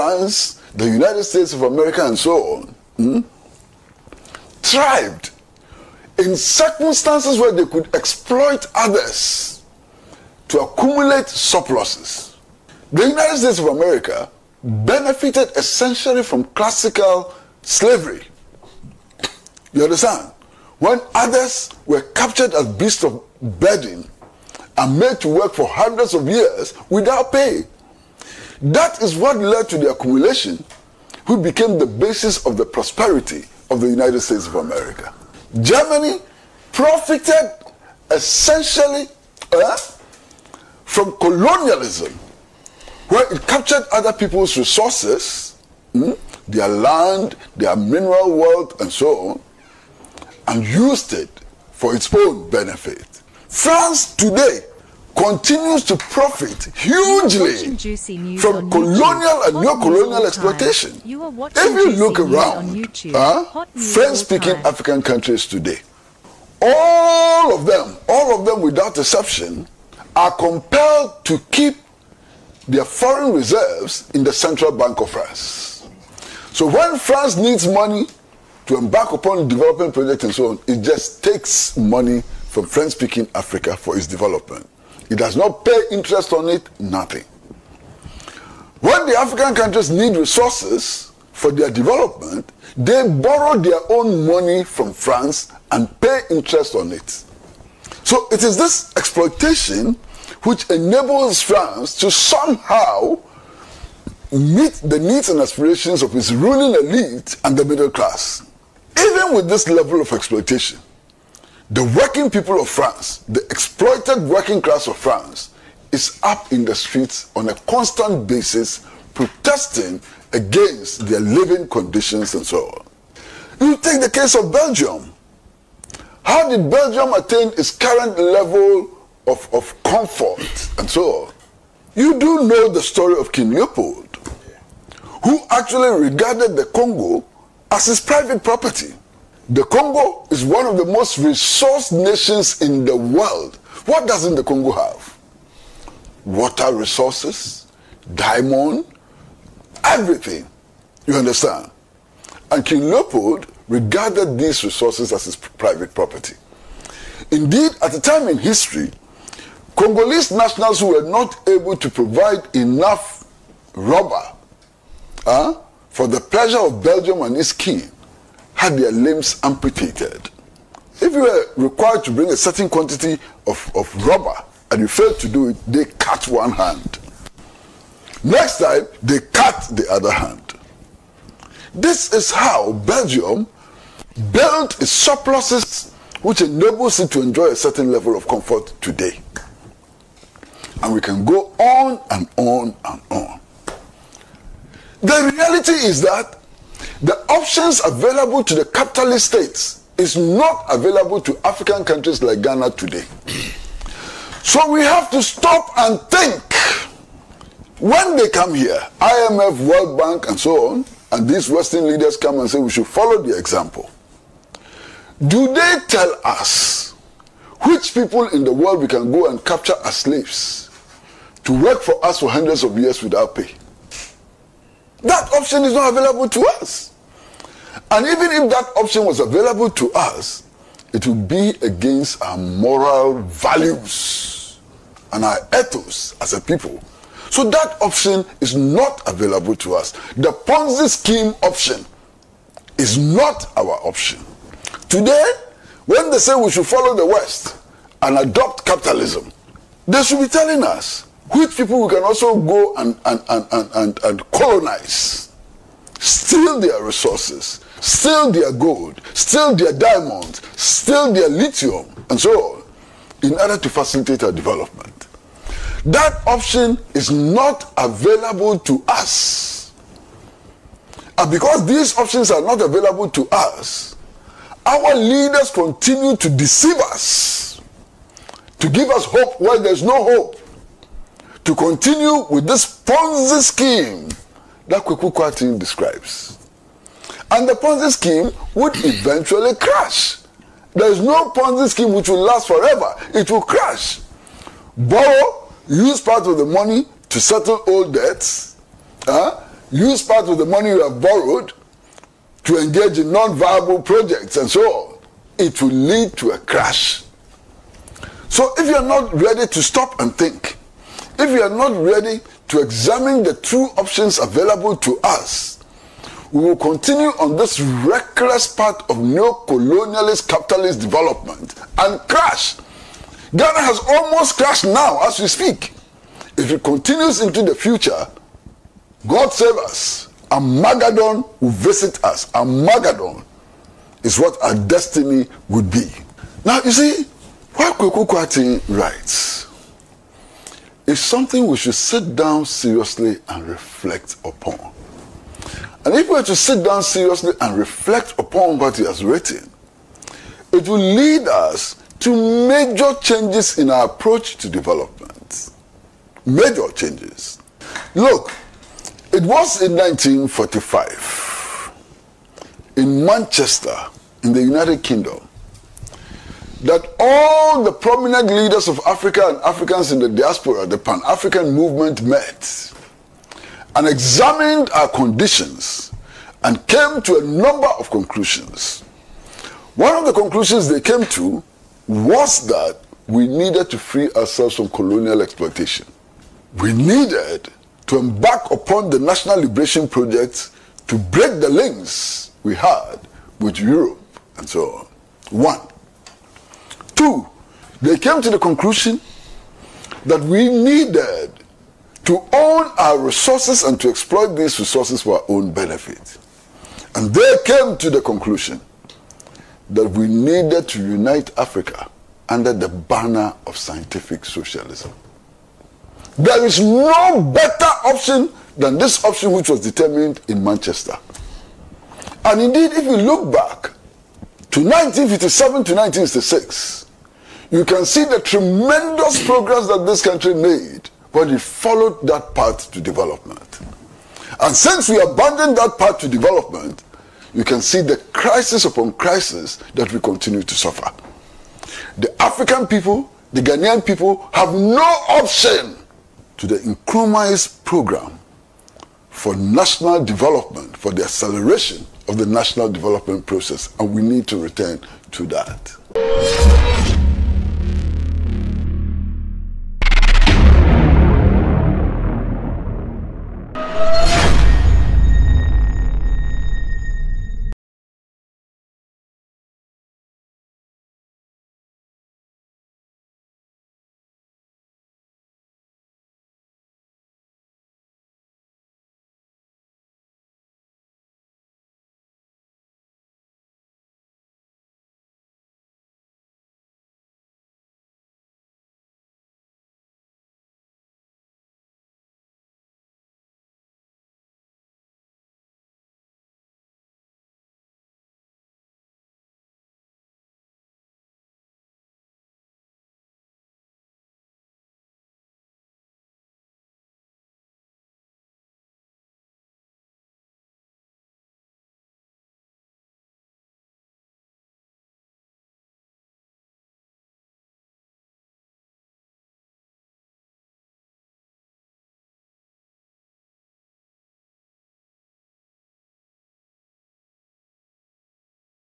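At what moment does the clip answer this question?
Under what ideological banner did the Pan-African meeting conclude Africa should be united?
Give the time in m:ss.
6:53.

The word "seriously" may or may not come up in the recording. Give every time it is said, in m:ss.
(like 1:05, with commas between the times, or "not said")
5:42, 5:46.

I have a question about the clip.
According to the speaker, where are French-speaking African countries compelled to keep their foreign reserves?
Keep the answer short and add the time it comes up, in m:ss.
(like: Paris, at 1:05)
Central Bank of France, at 1:14.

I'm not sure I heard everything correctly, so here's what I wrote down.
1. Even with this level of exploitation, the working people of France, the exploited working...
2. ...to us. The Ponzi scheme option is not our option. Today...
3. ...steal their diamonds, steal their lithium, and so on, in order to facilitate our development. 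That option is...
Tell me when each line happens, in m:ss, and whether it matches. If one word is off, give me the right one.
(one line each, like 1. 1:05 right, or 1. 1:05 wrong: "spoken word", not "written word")
1. 1:48 right
2. 3:59 right
3. 4:19 right.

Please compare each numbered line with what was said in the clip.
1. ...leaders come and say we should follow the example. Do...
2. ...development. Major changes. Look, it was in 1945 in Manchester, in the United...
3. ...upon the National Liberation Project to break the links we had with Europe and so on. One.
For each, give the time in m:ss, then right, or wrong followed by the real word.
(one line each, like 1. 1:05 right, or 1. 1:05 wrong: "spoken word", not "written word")
1. 3:31 right
2. 5:54 right
3. 6:28 right.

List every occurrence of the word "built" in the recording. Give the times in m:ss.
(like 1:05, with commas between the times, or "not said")
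3:04.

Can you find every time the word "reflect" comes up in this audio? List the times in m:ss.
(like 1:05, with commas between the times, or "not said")
5:43, 5:47.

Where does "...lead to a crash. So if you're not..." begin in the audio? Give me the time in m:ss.
5:05.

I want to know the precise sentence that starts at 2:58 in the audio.
Next time, they cut the other hand.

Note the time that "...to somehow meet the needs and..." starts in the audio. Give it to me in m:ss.
1:41.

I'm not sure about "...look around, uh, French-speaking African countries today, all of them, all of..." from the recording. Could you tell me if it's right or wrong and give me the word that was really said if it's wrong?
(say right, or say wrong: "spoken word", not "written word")
right.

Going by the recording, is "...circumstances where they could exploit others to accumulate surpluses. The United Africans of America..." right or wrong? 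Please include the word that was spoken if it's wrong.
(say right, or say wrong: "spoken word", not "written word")
wrong: "States", not "Africans".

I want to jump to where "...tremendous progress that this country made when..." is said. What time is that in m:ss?
7:08.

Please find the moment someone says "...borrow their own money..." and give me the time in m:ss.
1:33.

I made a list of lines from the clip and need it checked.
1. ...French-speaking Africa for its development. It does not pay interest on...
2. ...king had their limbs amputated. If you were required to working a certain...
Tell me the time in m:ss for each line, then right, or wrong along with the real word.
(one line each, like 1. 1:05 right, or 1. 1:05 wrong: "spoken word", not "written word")
1. 1:22 right
2. 2:47 wrong: "bring", not "working".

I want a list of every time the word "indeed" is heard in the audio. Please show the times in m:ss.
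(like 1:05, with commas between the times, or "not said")
2:37, 7:02.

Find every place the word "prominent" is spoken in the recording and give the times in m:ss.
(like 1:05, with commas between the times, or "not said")
6:07.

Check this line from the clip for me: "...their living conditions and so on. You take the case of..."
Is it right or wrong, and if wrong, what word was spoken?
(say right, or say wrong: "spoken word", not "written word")
right.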